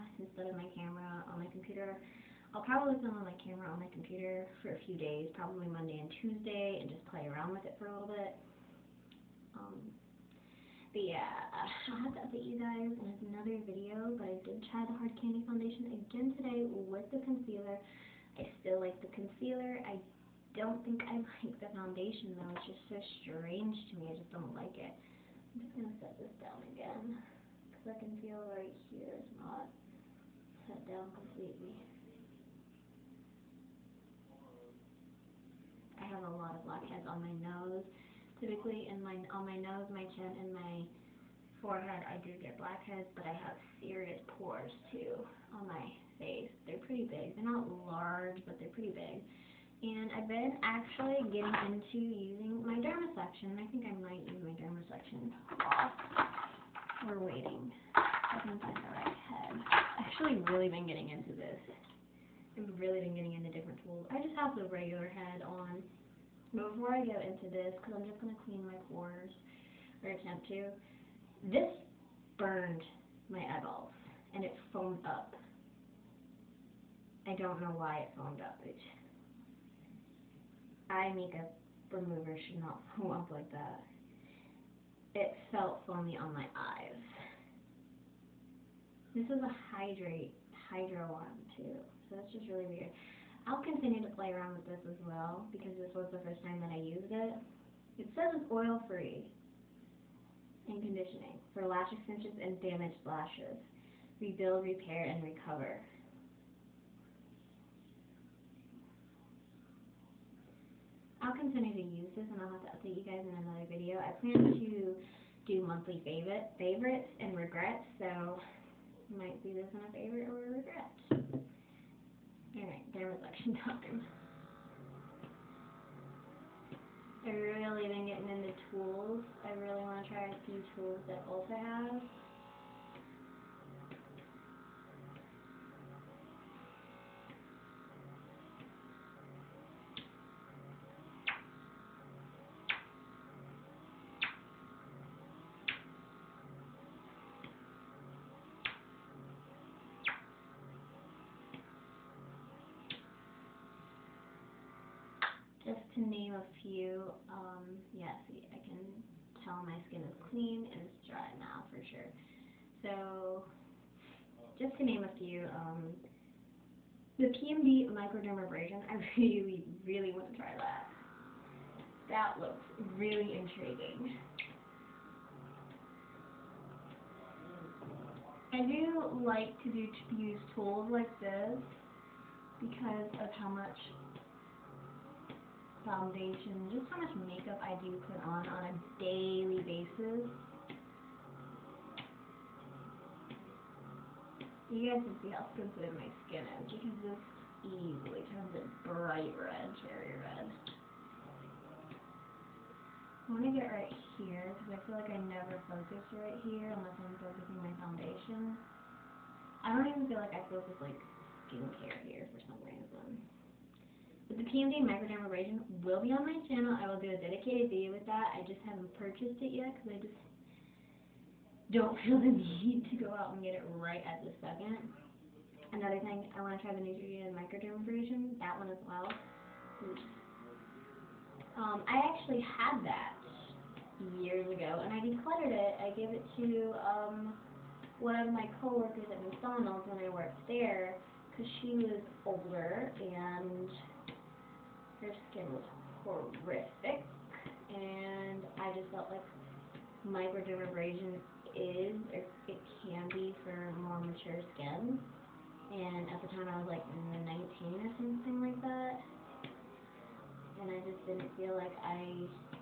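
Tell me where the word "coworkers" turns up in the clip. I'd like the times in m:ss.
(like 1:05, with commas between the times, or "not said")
3:58.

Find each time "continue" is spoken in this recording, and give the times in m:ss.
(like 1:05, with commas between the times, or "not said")
1:33, 1:51.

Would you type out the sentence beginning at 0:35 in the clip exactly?
I have a lot of blackheads on my nose.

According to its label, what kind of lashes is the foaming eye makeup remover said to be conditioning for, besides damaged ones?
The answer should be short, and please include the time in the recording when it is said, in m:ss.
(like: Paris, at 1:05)
Lash extensions, at 1:41.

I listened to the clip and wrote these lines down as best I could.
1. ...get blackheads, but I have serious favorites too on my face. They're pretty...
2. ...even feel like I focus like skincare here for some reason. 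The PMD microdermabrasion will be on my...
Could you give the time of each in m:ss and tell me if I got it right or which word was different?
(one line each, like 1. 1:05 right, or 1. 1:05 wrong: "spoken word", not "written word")
1. 0:42 wrong: "pores", not "favorites"
2. 3:29 right.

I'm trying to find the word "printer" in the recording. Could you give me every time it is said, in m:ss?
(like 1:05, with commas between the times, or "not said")
not said.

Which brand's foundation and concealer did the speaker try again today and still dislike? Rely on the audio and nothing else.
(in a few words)
Hard Candy.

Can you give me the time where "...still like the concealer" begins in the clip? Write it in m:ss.
0:18.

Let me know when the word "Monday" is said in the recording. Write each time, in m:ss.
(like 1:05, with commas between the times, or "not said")
0:05.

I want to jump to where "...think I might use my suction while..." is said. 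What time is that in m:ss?
0:53.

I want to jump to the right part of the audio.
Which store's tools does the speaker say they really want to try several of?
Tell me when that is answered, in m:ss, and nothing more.
2:11.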